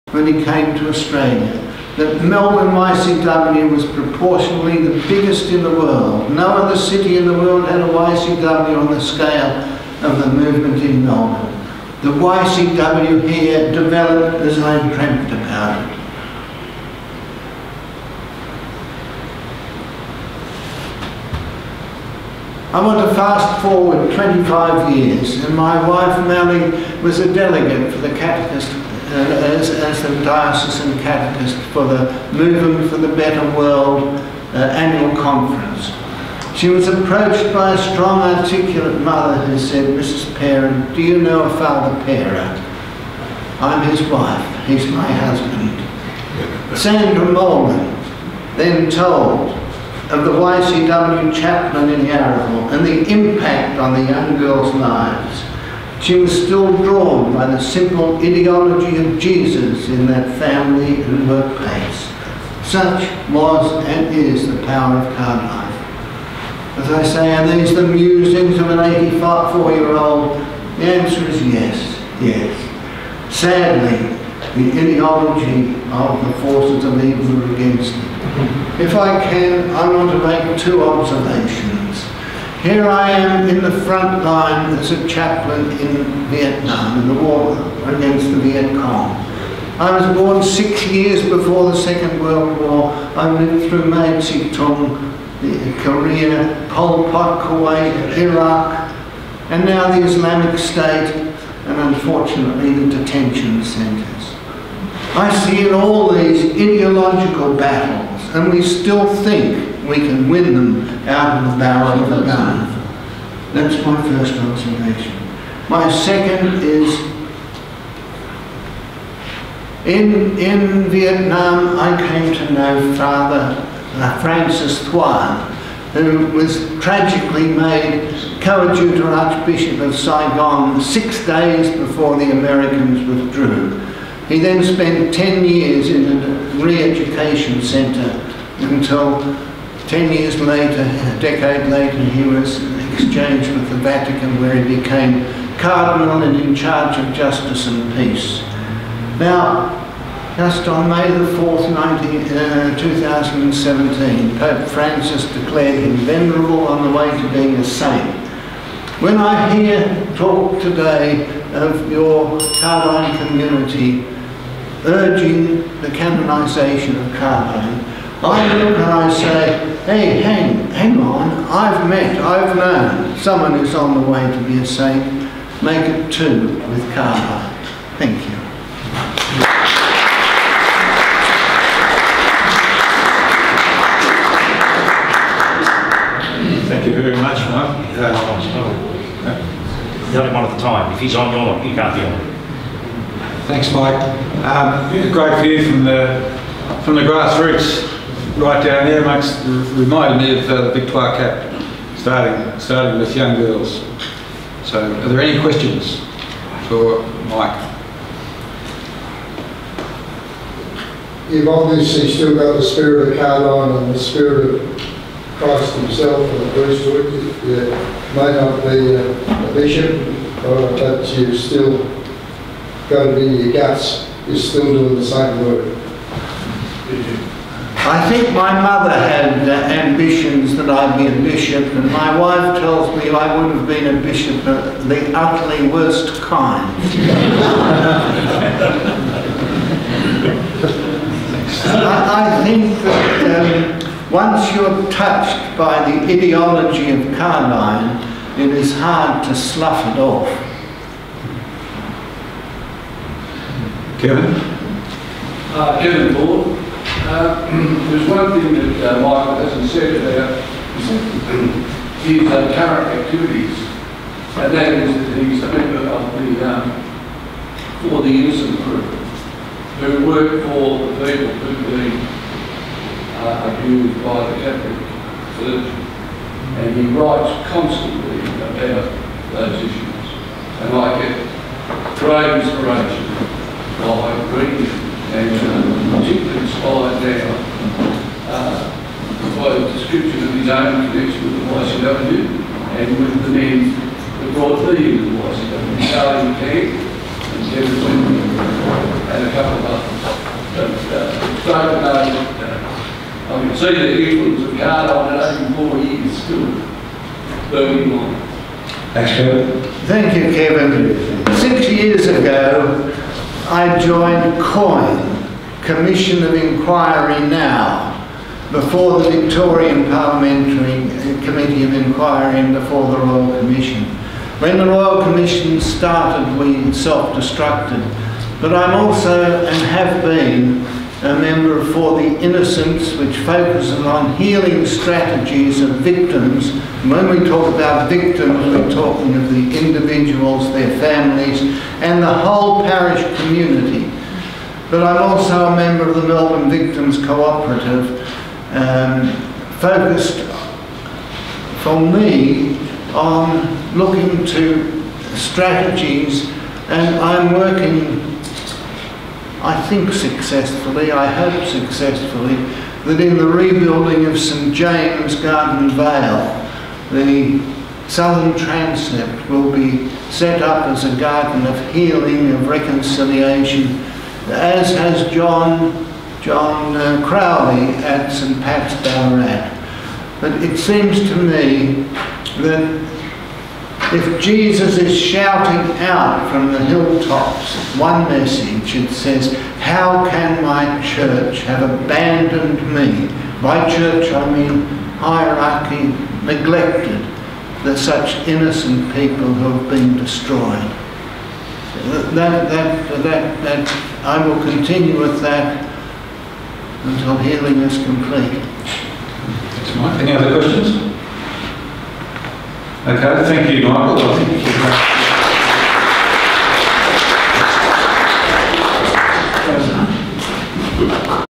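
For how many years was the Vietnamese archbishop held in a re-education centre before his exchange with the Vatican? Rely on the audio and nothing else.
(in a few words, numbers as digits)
10.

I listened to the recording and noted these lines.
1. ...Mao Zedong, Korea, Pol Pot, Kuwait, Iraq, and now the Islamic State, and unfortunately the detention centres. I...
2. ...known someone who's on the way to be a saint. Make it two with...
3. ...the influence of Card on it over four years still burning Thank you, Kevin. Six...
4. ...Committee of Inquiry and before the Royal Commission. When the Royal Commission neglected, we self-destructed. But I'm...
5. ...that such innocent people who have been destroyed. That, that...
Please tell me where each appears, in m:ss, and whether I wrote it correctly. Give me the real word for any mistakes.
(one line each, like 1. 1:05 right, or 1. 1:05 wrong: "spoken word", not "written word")
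1. 1:33 right
2. 2:52 right
3. 5:03 right
4. 5:21 wrong: "started", not "neglected"
5. 6:37 right.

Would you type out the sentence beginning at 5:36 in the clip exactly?
When we talk about victims, we're talking of the individuals, their families, and the whole parish community.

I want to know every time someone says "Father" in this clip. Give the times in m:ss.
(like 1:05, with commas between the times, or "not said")
0:41, 2:02.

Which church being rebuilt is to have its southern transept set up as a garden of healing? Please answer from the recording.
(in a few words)
St James Gardenvale.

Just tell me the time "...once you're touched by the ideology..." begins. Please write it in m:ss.
4:04.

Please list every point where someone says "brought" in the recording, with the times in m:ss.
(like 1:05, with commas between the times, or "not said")
4:54.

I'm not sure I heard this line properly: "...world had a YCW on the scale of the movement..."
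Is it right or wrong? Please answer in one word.
right.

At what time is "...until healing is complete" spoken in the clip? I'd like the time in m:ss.
6:46.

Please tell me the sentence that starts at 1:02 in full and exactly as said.
Such was and is the power of card life.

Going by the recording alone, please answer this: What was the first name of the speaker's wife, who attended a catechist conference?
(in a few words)
Mally.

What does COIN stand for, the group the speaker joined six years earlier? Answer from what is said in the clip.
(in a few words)
Commission of Inquiry Now.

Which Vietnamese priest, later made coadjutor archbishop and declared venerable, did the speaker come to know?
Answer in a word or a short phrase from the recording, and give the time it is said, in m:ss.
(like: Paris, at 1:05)
Francis Thuan, at 2:04.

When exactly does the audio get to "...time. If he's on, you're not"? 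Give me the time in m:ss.
3:10.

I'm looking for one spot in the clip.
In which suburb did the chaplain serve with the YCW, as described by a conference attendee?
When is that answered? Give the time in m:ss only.
0:52.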